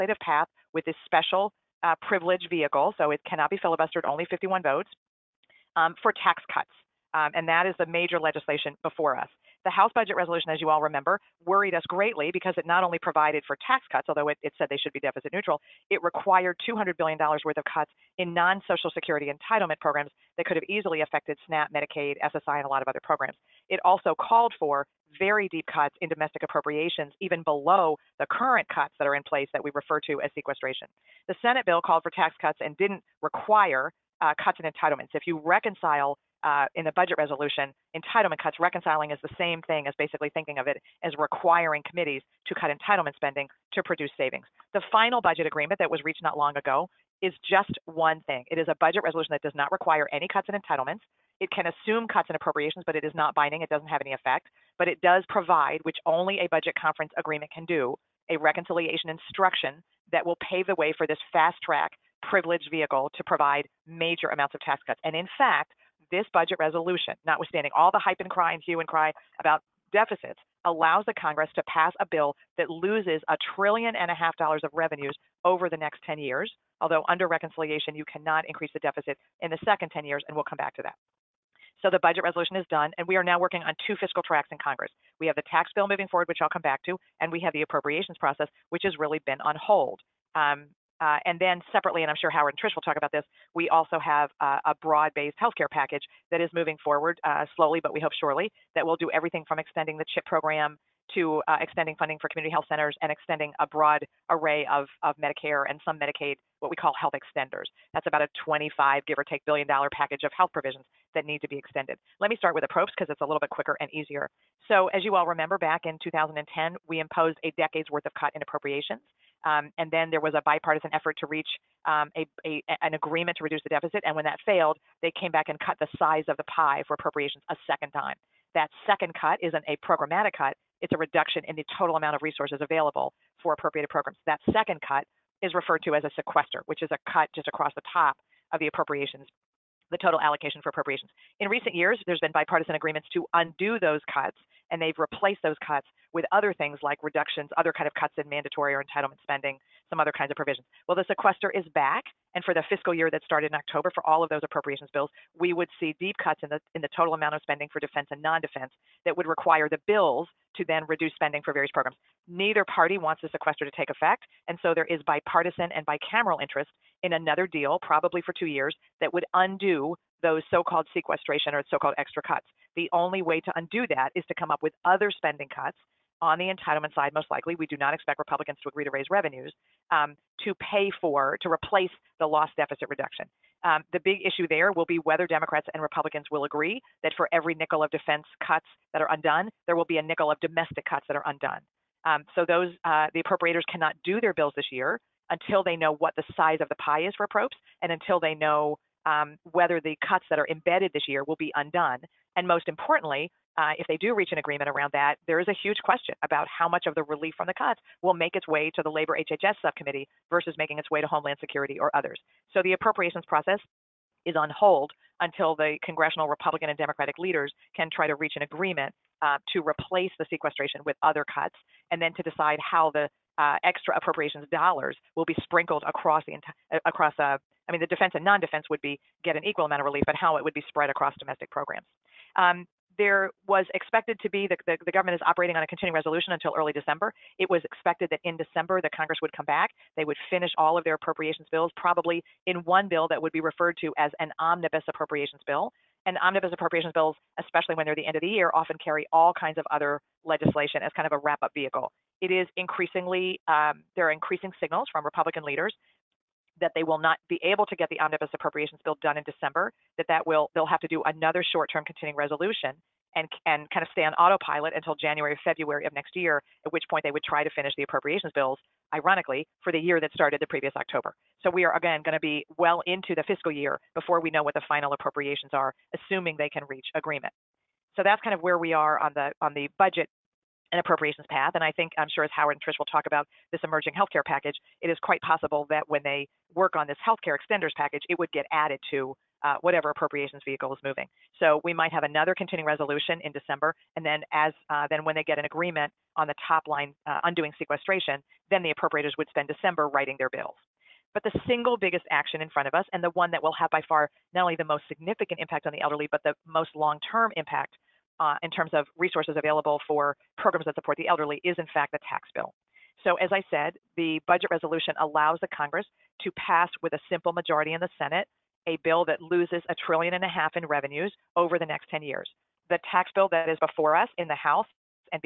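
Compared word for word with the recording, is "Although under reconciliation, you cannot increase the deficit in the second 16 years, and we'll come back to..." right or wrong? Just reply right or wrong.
wrong.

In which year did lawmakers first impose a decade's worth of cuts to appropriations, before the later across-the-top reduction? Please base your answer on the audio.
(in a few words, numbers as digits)
2010.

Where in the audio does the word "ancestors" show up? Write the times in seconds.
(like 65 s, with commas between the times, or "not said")
not said.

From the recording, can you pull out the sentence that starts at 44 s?
The final budget agreement that was reached not long ago is just one thing.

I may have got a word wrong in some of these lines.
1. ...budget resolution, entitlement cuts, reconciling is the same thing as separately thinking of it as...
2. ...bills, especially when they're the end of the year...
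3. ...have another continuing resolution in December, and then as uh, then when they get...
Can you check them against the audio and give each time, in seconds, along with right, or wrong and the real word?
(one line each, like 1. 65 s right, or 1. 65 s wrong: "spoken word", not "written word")
1. 36 s wrong: "basically", not "separately"
2. 246 s right
3. 291 s right.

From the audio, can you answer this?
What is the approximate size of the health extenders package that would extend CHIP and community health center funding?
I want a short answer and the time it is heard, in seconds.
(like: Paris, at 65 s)
$25 billion, at 108 s.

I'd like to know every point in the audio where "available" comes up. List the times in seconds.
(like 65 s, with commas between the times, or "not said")
132 s, 309 s.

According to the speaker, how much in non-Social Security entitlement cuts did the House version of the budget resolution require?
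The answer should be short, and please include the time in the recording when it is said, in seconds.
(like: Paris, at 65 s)
$200 billion, at 16 s.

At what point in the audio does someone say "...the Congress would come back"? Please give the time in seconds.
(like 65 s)
238 s.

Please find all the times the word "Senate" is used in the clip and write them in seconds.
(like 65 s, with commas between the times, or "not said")
31 s, 317 s.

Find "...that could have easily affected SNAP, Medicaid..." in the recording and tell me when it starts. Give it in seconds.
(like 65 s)
20 s.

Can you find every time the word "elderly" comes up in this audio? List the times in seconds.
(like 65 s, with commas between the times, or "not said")
305 s, 311 s.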